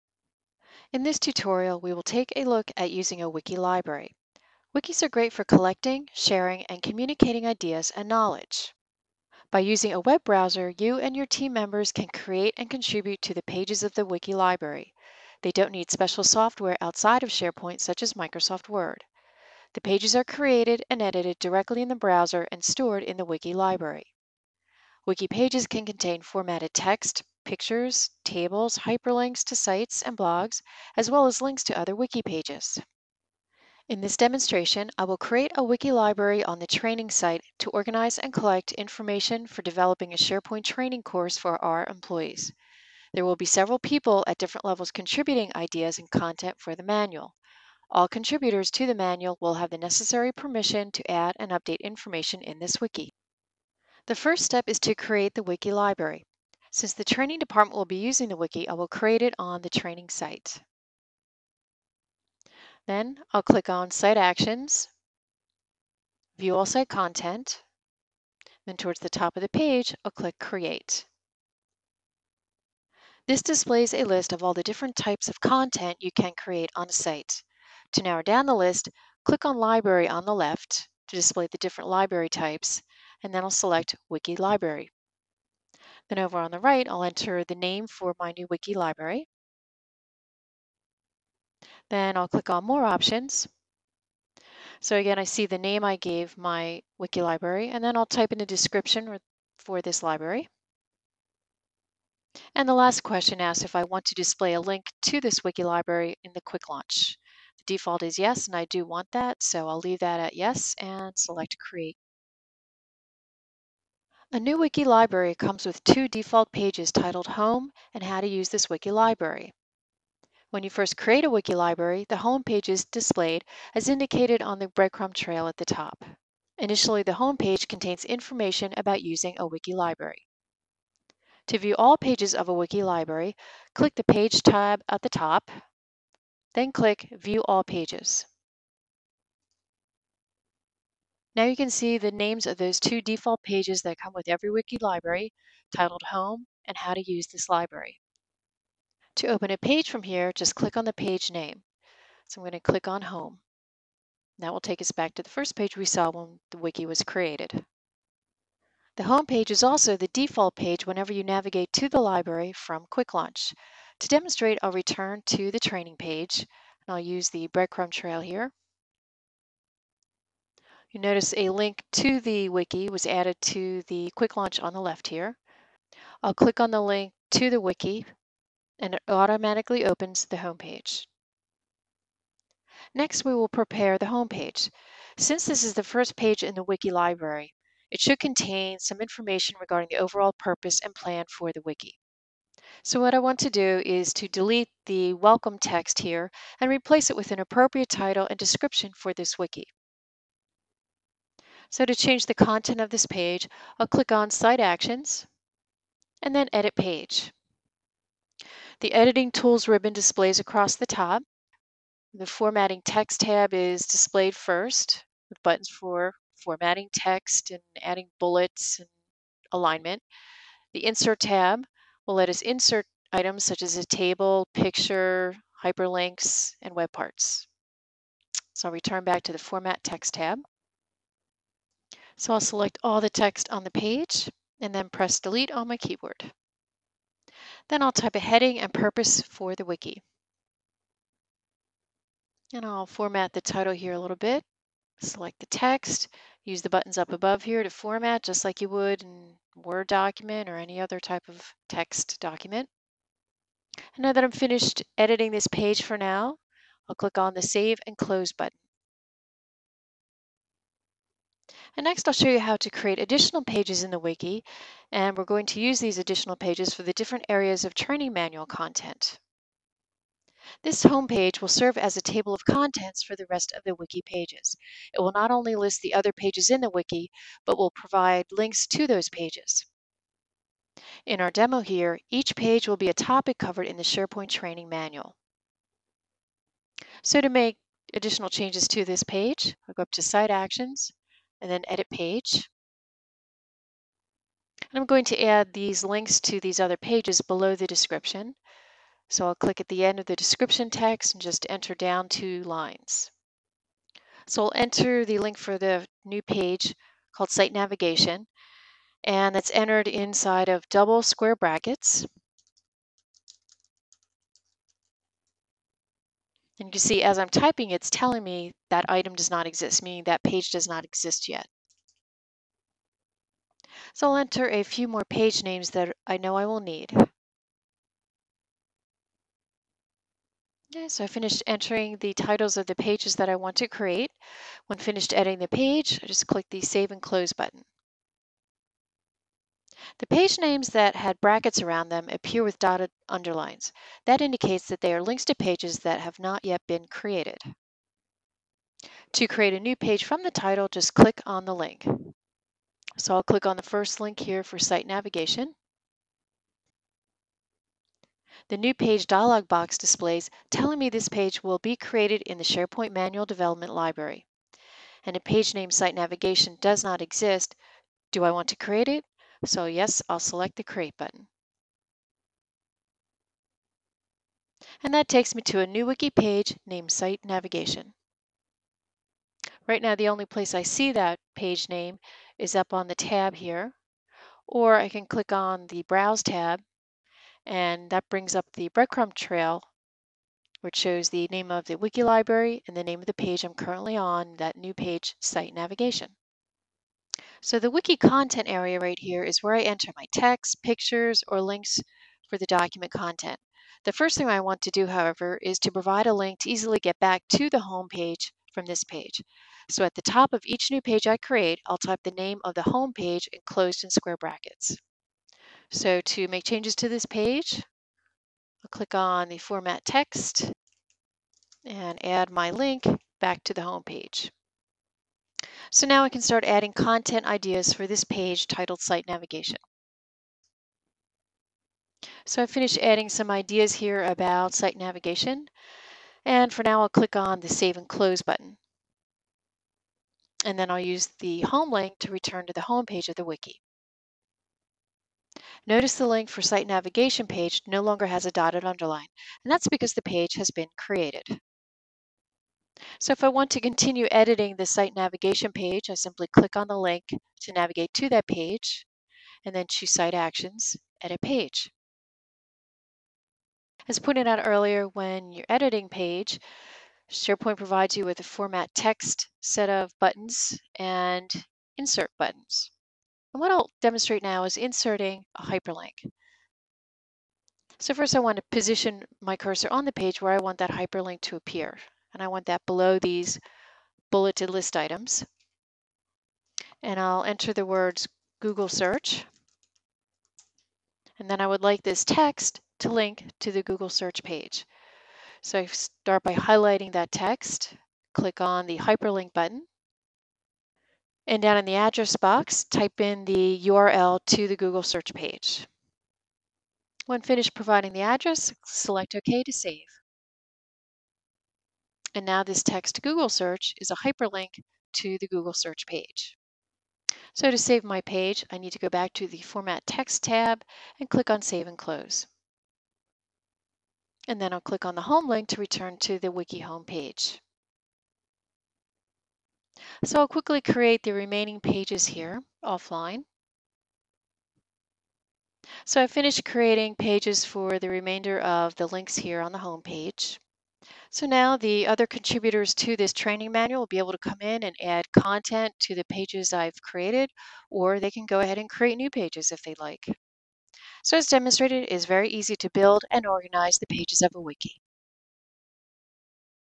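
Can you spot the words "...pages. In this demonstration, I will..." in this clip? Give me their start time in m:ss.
0:32.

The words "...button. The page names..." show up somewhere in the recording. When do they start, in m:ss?
5:37.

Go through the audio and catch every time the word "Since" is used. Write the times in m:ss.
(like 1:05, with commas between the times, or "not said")
0:56, 3:05.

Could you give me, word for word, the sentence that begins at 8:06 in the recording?
And I'll enter the words Google search.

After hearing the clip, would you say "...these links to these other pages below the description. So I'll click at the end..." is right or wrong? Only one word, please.
right.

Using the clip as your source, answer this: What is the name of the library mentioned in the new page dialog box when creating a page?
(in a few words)
SharePoint Manual Development.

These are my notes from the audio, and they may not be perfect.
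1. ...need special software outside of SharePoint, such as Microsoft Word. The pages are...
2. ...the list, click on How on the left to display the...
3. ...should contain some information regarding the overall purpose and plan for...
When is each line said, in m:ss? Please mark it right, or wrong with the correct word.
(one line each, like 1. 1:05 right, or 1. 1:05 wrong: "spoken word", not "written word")
1. 0:15 right
2. 1:18 wrong: "Library", not "How"
3. 3:08 right.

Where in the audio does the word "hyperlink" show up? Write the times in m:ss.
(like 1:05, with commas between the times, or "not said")
0:28, 3:45, 7:55, 8:00, 8:18, 8:33.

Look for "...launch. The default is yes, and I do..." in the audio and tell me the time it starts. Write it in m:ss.
1:46.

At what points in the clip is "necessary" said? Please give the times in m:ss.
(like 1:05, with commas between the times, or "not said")
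0:49.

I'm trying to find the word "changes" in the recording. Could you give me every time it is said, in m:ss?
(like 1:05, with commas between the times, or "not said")
3:21, 4:48, 6:56.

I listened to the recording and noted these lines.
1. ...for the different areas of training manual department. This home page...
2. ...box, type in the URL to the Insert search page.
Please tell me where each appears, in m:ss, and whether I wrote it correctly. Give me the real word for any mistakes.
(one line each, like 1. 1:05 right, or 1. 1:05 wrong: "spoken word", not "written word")
1. 4:26 wrong: "content", not "department"
2. 8:22 wrong: "Google", not "Insert".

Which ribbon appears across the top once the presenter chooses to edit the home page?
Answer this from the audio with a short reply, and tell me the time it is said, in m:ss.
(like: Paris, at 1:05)
Editing Tools, at 3:28.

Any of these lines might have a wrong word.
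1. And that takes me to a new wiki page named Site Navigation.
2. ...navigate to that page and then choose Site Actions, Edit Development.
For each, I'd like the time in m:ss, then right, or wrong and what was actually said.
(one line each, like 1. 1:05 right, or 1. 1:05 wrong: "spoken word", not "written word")
1. 6:14 right
2. 7:37 wrong: "Page", not "Development".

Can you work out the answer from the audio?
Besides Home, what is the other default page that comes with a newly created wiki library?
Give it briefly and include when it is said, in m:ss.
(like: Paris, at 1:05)
How to Use this Wiki Library, at 1:58.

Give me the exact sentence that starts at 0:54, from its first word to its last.
The first step is to create the wiki library.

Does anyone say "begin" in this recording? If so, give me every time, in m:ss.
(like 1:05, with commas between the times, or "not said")
not said.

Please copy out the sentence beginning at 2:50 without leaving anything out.
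You notice a link to the wiki was added to the quick launch on the left here.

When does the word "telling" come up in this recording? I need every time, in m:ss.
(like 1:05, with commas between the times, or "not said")
5:17, 6:00.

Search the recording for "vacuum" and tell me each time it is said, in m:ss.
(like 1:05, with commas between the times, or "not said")
not said.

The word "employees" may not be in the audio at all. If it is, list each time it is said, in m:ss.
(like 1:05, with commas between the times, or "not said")
0:41.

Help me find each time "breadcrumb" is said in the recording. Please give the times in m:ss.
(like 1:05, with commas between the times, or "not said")
2:04, 2:47, 6:28.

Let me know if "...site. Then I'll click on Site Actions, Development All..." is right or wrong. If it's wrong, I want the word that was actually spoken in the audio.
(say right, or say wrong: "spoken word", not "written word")
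wrong: "View", not "Development".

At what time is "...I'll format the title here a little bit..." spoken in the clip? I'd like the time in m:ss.
4:02.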